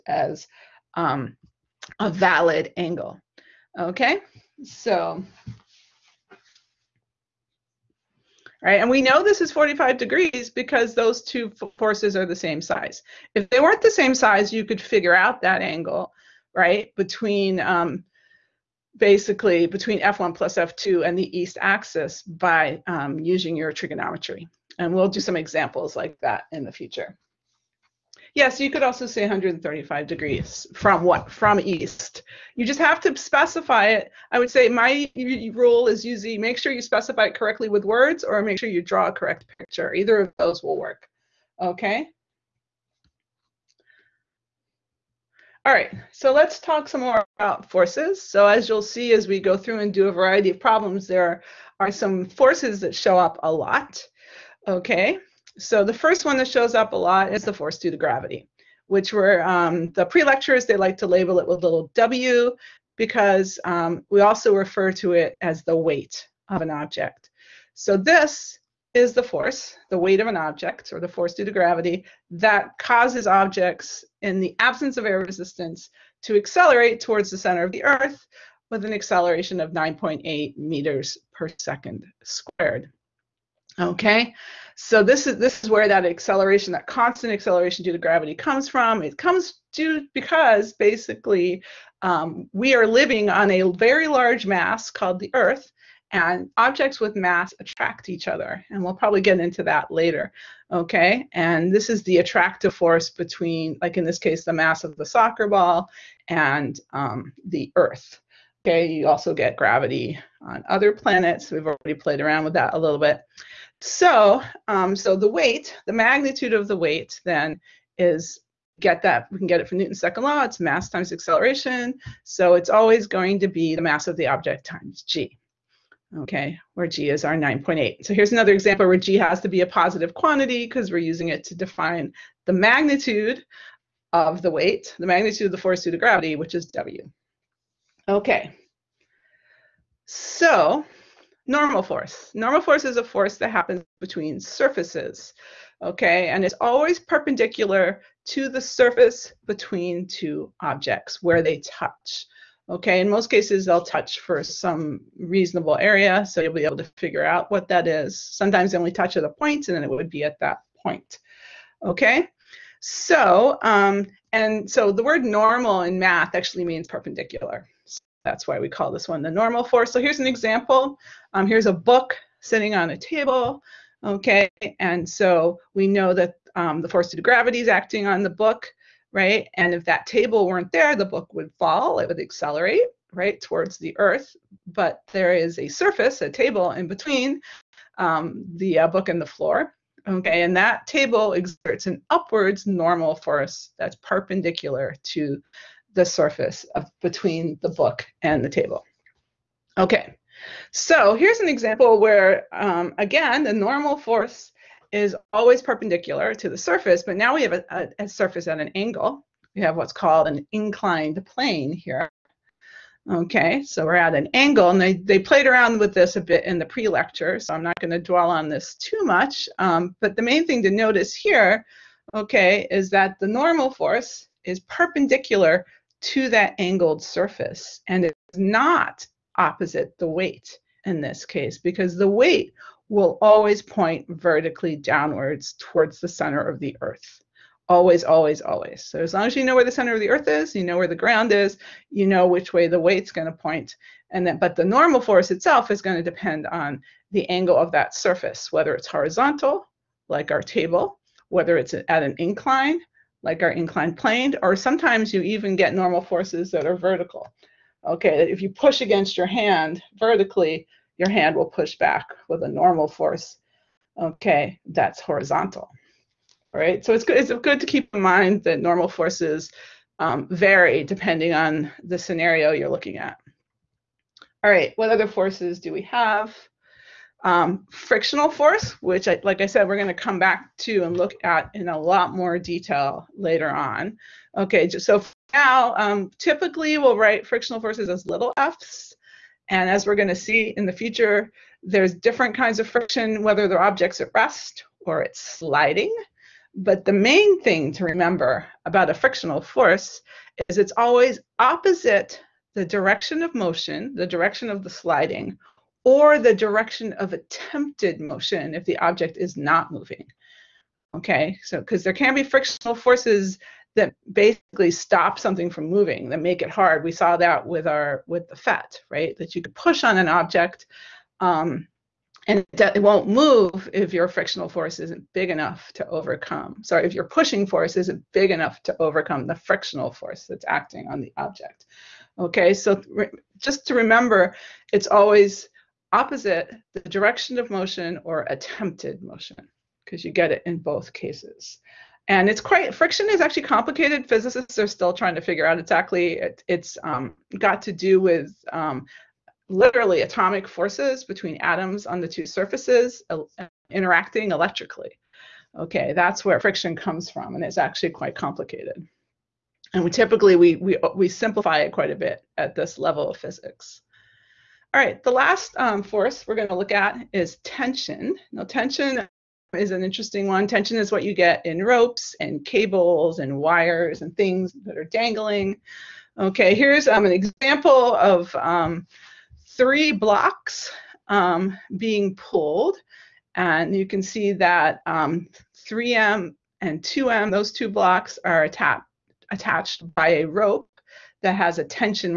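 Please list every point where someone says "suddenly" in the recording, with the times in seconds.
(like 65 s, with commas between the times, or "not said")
not said.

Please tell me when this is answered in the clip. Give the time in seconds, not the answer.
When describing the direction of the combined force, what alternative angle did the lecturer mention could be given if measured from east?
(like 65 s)
29 s.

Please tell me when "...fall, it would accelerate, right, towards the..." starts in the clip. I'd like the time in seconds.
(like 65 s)
181 s.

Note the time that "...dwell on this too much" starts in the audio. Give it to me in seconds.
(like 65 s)
217 s.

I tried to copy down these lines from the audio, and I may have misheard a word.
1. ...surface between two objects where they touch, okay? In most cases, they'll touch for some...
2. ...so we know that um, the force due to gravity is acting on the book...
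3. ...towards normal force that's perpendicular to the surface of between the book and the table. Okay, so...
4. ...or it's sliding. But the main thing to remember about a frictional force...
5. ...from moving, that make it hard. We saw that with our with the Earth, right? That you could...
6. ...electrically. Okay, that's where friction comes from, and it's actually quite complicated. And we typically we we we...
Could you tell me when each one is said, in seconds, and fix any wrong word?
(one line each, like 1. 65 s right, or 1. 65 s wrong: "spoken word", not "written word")
1. 148 s right
2. 175 s right
3. 192 s wrong: "upwards", not "towards"
4. 294 s right
5. 315 s wrong: "PhET", not "Earth"
6. 354 s right.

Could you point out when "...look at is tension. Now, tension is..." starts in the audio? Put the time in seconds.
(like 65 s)
366 s.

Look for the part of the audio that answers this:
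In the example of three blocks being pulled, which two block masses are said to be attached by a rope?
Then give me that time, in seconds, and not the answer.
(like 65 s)
384 s.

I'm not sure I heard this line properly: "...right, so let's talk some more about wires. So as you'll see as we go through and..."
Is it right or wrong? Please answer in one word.
wrong.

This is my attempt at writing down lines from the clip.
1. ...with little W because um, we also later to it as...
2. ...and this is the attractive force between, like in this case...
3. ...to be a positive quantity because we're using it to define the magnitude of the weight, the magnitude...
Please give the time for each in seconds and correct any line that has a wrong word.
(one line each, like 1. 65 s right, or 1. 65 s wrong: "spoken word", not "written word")
1. 61 s wrong: "refer", not "later"
2. 101 s right
3. 129 s right.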